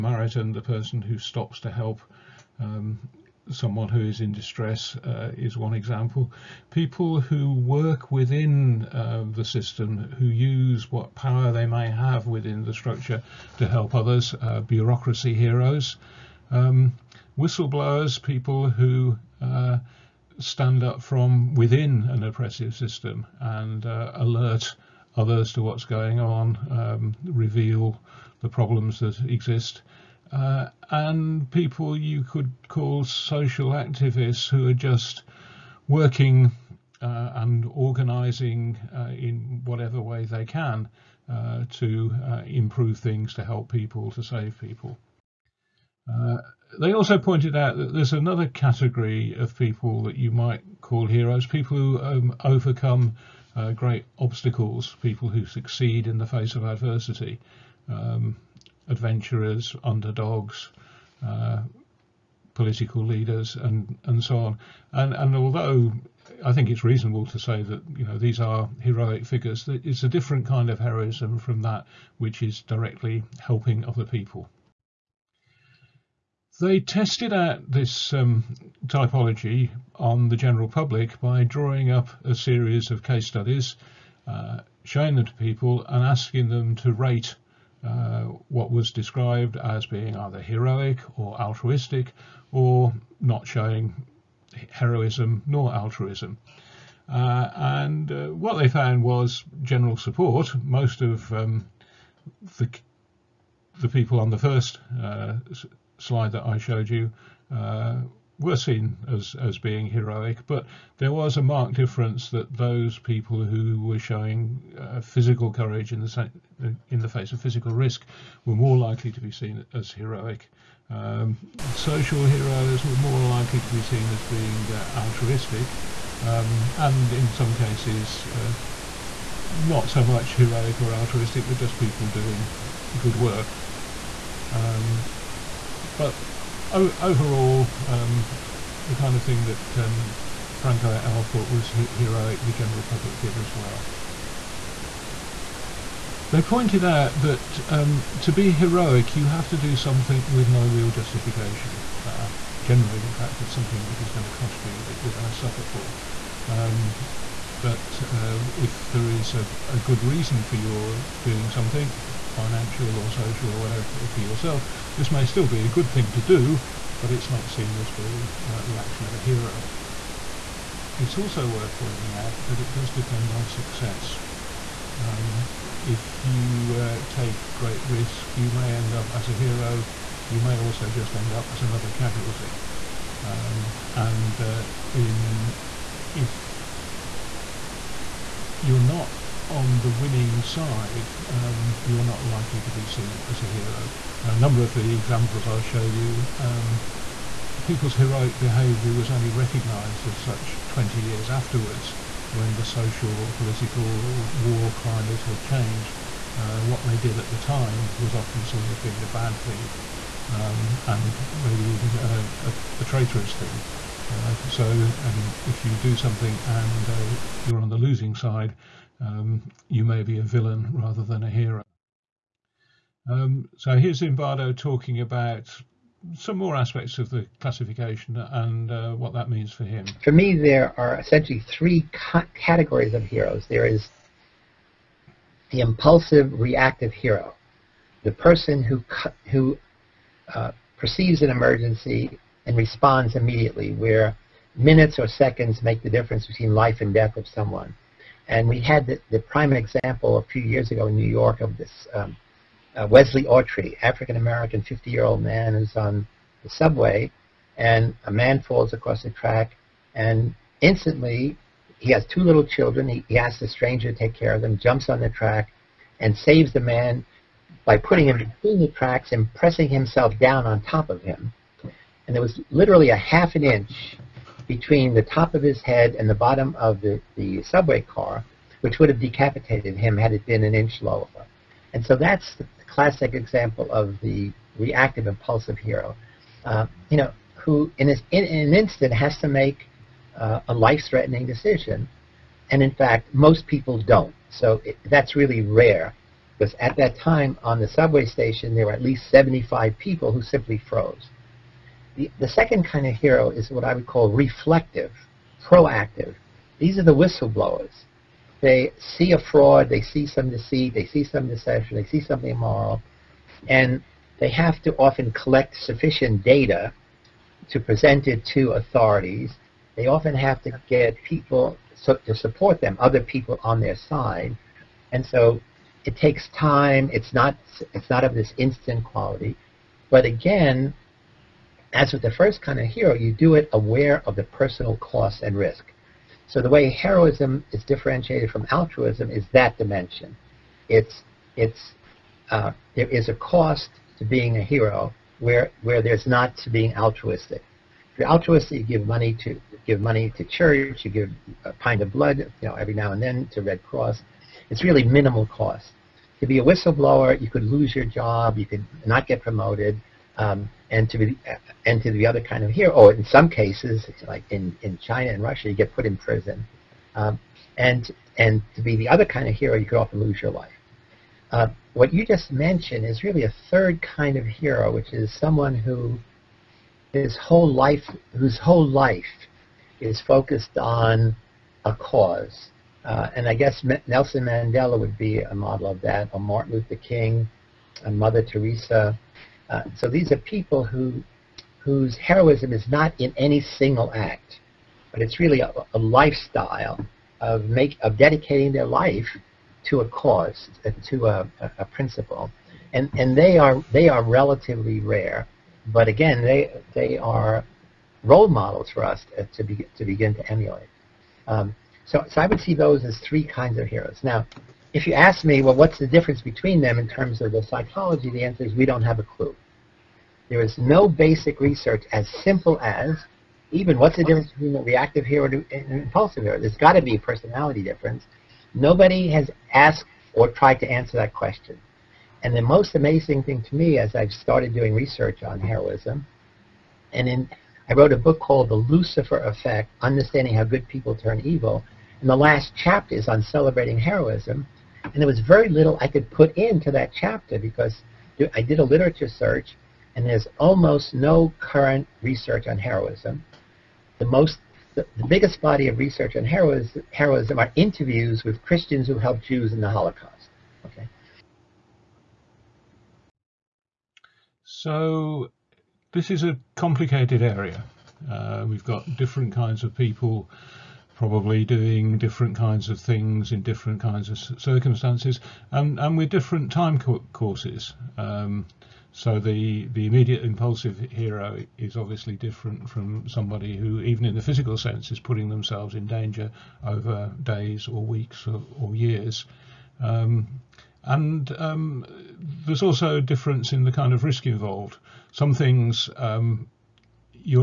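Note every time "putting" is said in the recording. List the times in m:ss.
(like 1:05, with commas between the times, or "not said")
4:27, 8:04.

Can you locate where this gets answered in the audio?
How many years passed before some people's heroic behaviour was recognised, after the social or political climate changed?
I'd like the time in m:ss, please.
3:20.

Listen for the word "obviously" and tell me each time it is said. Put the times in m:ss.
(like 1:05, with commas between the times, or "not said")
8:01.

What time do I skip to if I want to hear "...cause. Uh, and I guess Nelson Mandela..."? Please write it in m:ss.
6:21.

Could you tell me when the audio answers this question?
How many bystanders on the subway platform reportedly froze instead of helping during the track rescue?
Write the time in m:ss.
4:59.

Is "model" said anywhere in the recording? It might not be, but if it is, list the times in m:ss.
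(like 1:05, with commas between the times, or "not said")
6:25, 6:48.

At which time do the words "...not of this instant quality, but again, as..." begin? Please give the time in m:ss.
5:27.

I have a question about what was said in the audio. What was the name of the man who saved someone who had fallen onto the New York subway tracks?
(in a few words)
Wesley Autry.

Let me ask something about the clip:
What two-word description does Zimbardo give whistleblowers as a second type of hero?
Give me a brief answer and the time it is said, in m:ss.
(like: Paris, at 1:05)
reflective, proactive, at 5:04.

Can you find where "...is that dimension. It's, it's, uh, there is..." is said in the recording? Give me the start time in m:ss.
5:39.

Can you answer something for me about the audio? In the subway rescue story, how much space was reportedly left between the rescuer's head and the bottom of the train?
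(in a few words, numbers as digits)
half an inch.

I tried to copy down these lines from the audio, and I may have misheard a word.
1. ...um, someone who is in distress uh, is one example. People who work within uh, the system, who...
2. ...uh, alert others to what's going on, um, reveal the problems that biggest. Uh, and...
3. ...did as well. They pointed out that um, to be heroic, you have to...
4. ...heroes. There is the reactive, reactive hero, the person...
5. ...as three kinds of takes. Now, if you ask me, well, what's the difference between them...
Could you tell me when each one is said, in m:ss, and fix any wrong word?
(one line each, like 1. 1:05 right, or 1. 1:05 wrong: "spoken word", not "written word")
1. 0:02 right
2. 0:23 wrong: "exist", not "biggest"
3. 2:23 right
4. 3:53 wrong: "impulsive", not "reactive"
5. 6:52 wrong: "heroes", not "takes".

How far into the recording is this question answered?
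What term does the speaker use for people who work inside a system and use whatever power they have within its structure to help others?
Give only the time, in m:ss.
0:14.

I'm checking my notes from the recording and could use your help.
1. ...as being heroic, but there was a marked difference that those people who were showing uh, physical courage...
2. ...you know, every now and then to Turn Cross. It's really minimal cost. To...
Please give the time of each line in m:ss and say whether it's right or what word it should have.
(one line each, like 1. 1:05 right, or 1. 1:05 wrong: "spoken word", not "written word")
1. 1:49 right
2. 5:52 wrong: "Red", not "Turn".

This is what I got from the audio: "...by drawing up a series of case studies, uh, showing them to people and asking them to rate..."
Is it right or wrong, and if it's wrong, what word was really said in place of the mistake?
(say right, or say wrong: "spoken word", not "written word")
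right.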